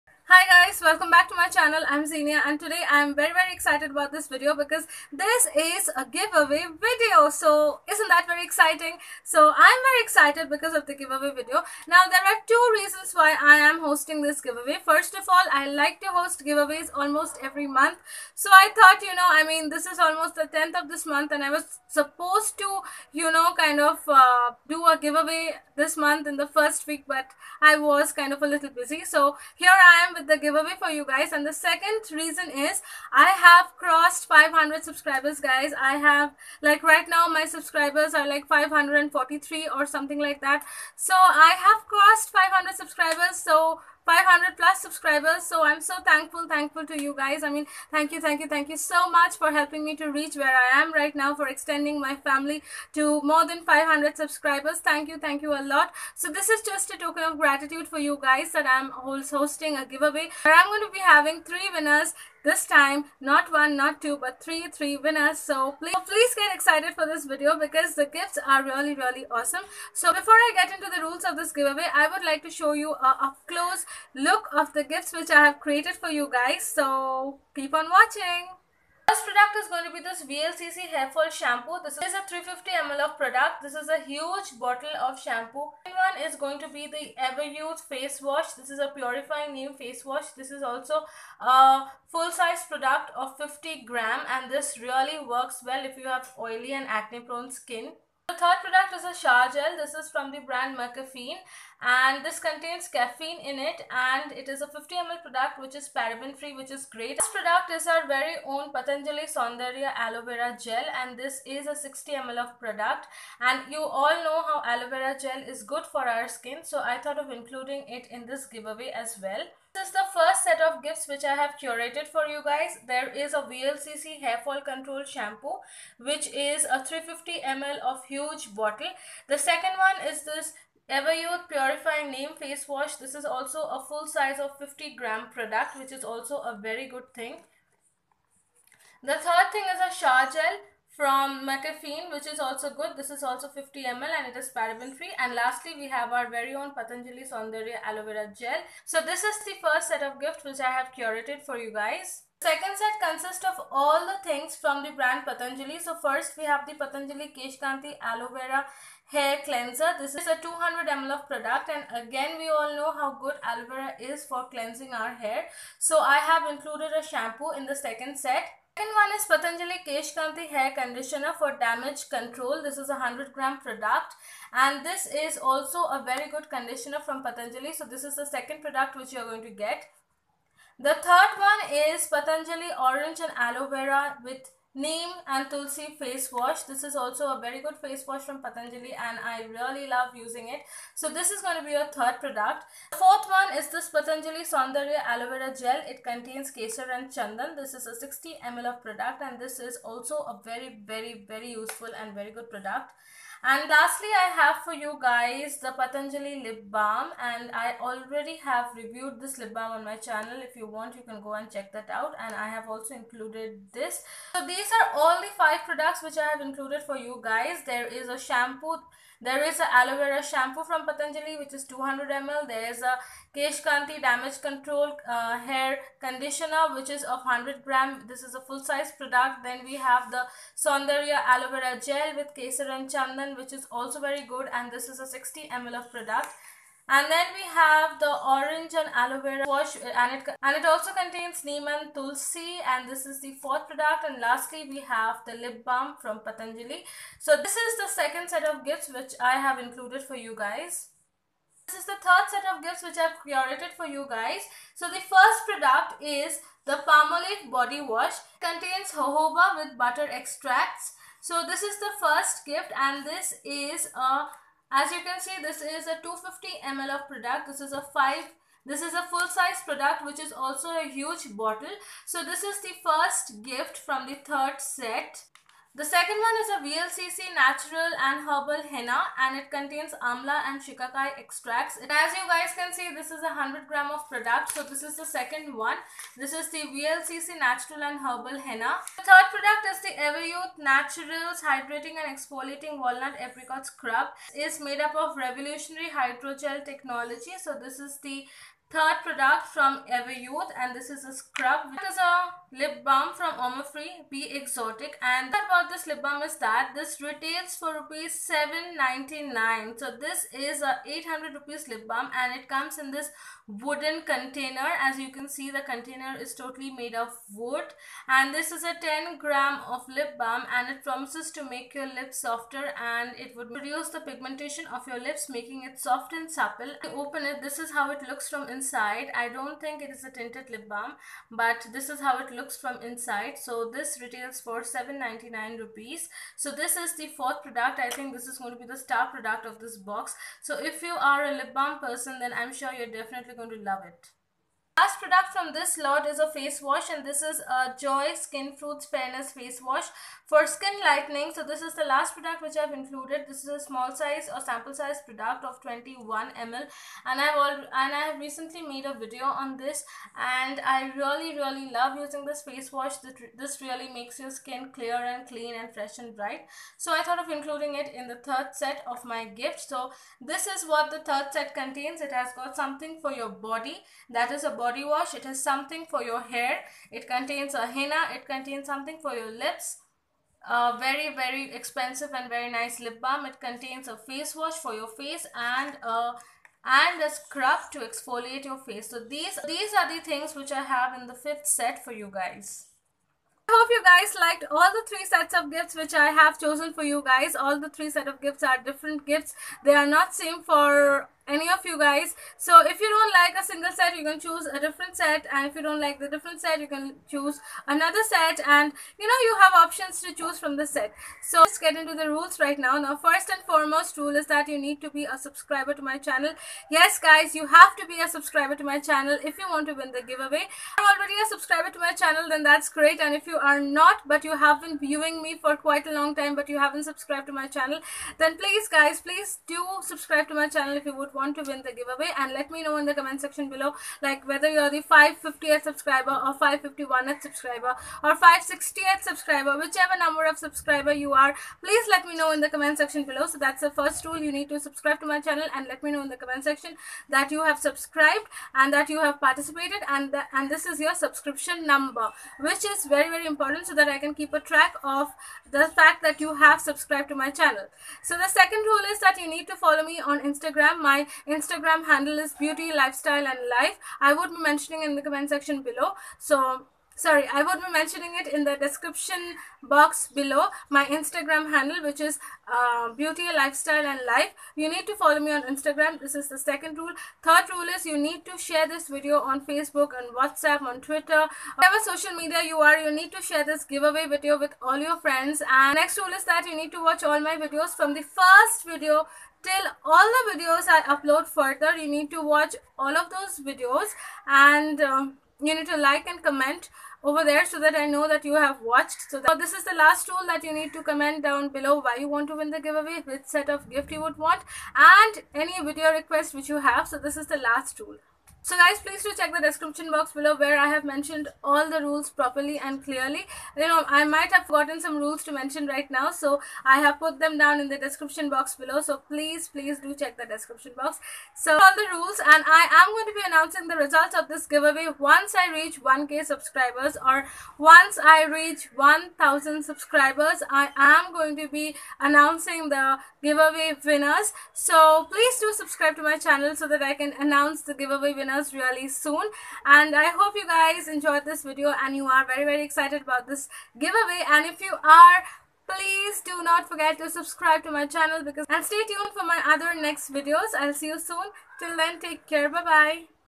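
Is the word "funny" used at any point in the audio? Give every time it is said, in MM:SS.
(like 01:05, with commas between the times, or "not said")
not said.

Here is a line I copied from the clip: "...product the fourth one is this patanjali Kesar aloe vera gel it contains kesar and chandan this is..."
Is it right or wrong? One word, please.
wrong.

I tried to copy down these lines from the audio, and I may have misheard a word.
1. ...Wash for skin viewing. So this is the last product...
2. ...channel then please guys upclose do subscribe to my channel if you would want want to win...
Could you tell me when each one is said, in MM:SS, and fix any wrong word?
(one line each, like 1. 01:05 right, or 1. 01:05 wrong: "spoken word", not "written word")
1. 05:49 wrong: "lightening", not "viewing"
2. 07:07 wrong: "please", not "upclose".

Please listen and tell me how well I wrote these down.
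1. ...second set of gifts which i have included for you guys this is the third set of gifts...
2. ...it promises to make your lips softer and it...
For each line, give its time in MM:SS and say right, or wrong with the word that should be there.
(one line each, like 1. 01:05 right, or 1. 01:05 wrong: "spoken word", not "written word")
1. 04:07 right
2. 05:20 right.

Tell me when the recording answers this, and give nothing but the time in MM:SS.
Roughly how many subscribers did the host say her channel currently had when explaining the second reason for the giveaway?
00:38.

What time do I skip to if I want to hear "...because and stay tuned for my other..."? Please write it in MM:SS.
09:08.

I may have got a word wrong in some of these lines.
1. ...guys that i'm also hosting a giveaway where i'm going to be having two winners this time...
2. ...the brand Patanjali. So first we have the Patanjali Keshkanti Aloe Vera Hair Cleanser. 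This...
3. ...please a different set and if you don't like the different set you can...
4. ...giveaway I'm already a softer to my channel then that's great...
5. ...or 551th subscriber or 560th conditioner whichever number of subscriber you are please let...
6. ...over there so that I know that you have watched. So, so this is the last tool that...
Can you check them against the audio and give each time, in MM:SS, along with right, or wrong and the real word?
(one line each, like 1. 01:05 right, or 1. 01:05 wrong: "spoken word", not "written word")
1. 00:58 wrong: "three", not "two"
2. 02:34 right
3. 06:44 wrong: "choose", not "please"
4. 07:00 wrong: "subscriber", not "softer"
5. 07:16 wrong: "subscriber", not "conditioner"
6. 08:17 right.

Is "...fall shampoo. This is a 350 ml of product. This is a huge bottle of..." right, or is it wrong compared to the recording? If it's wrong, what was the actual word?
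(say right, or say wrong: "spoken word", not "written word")
right.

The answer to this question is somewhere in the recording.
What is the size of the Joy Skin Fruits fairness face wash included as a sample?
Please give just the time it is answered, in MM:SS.
05:55.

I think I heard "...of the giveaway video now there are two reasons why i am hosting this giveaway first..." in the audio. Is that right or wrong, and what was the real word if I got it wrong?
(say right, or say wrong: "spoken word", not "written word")
right.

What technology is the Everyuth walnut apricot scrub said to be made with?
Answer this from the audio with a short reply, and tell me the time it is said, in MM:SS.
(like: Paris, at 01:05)
Revolutionary hydrogel technology, at 04:55.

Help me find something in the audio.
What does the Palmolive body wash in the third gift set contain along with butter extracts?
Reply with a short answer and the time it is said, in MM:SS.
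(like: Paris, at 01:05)
Jojoba, at 04:18.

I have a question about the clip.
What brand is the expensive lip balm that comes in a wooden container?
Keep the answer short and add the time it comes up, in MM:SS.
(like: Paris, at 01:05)
Omofree, at 05:03.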